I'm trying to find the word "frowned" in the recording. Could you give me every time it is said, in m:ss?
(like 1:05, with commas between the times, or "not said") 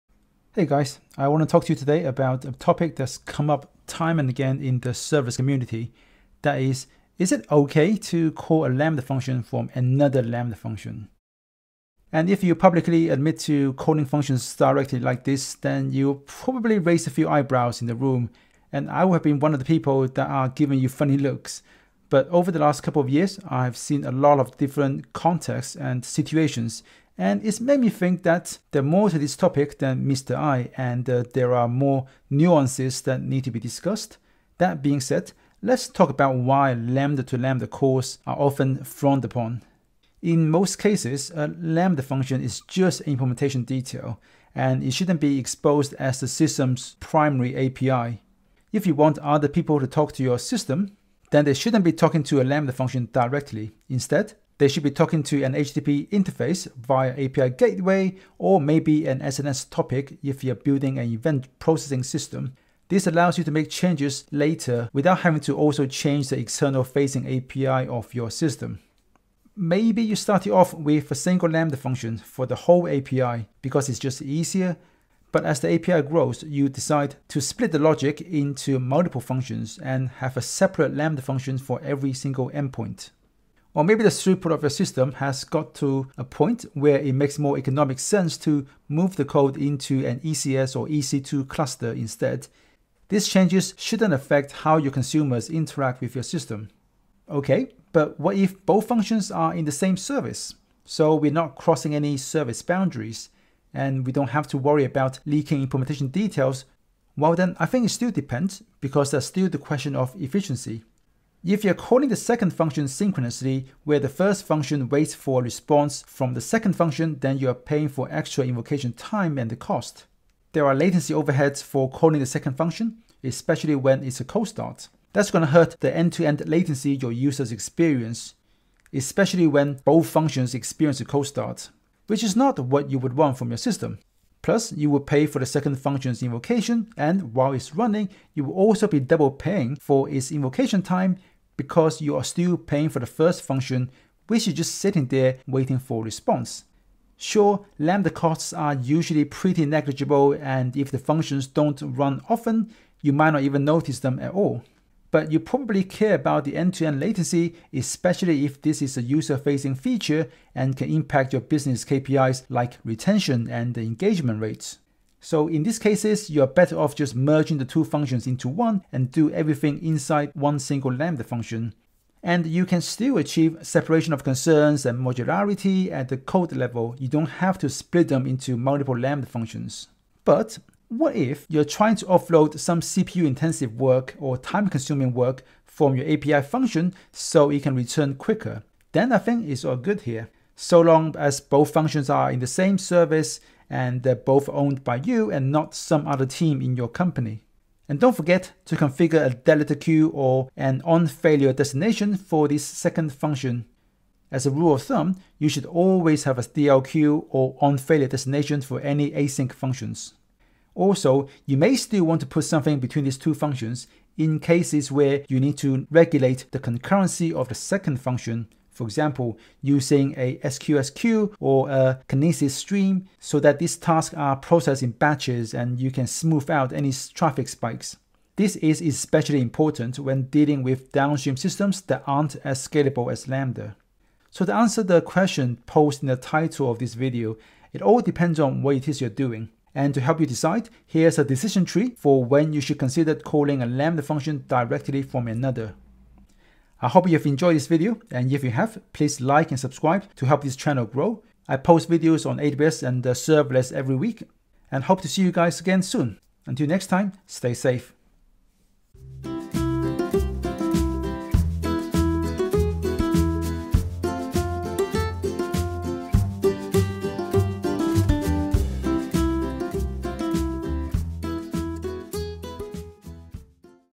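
0:38.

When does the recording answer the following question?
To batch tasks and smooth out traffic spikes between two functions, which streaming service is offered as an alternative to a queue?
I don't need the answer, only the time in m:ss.
3:42.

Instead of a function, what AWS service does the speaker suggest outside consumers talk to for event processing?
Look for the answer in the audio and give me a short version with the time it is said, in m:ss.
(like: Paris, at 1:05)
SNS topic, at 0:59.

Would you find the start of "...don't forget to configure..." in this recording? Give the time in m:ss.
3:18.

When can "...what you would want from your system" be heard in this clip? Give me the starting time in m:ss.
2:12.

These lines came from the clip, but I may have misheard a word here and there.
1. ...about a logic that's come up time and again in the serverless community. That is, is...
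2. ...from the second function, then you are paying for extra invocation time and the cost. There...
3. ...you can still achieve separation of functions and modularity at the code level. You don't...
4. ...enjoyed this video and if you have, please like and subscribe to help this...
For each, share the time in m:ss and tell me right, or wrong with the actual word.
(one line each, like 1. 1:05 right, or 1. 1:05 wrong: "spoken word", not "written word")
1. 0:02 wrong: "topic", not "logic"
2. 1:56 right
3. 2:52 wrong: "concerns", not "functions"
4. 4:07 right.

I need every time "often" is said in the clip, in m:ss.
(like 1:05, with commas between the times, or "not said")
0:38, 2:32.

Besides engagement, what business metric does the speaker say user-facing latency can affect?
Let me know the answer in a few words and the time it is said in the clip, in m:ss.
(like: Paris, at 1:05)
Retention, at 2:42.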